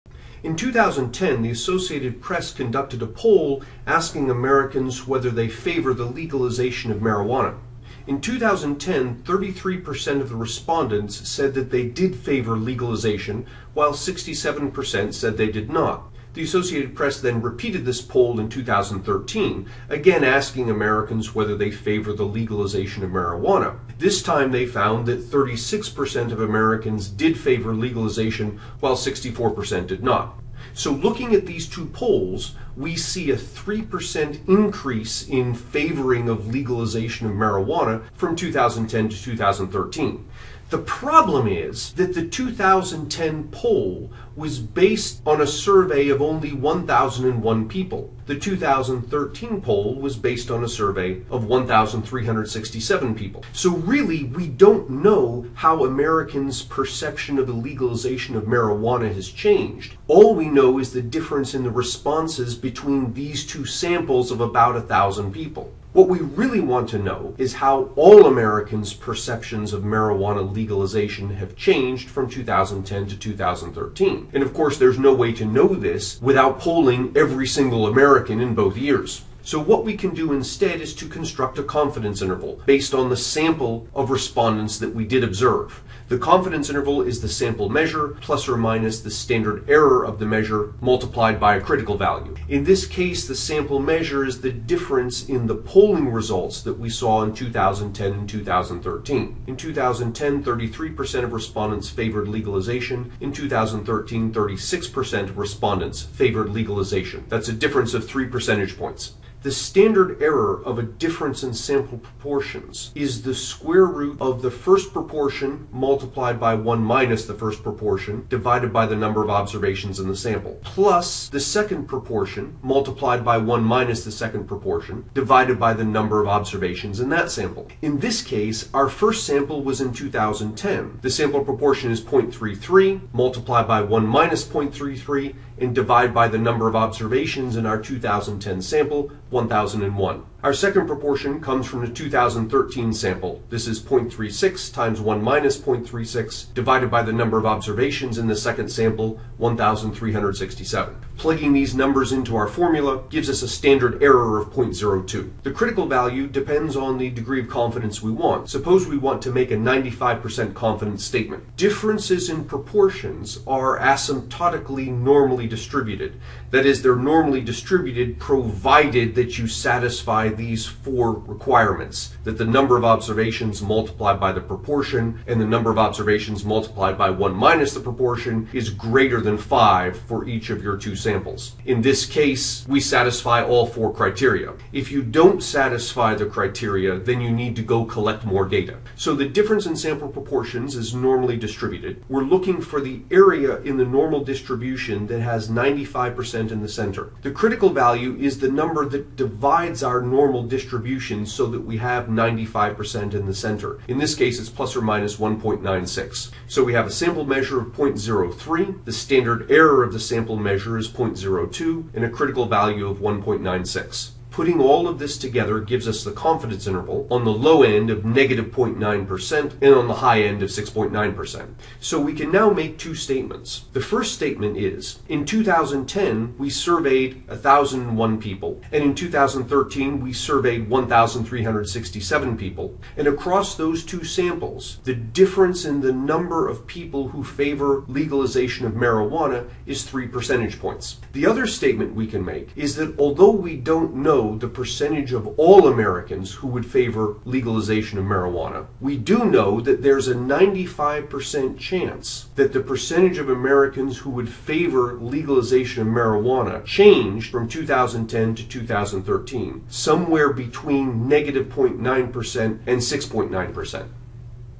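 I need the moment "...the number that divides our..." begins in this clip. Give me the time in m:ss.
3:18.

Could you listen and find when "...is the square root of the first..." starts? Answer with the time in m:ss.
1:52.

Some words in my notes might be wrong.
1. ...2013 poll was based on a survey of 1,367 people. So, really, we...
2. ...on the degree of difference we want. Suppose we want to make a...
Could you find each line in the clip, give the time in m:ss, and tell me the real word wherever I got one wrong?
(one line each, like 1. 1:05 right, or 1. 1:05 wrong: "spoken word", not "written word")
1. 0:48 right
2. 2:36 wrong: "confidence", not "difference".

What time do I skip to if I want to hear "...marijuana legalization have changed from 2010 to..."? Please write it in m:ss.
1:09.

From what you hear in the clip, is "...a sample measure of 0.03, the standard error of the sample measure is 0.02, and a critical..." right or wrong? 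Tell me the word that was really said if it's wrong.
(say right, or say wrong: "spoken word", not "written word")
right.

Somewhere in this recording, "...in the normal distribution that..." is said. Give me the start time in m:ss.
3:13.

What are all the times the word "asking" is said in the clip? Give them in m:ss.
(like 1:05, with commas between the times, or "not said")
0:03, 0:20.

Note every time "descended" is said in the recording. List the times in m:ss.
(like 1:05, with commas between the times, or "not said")
not said.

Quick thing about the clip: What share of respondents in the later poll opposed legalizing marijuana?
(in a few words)
64%.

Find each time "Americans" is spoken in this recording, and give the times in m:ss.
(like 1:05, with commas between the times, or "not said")
0:04, 0:20, 0:26, 0:55, 1:08, 1:17, 4:05, 4:13.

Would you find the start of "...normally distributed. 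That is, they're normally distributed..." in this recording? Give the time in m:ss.
2:44.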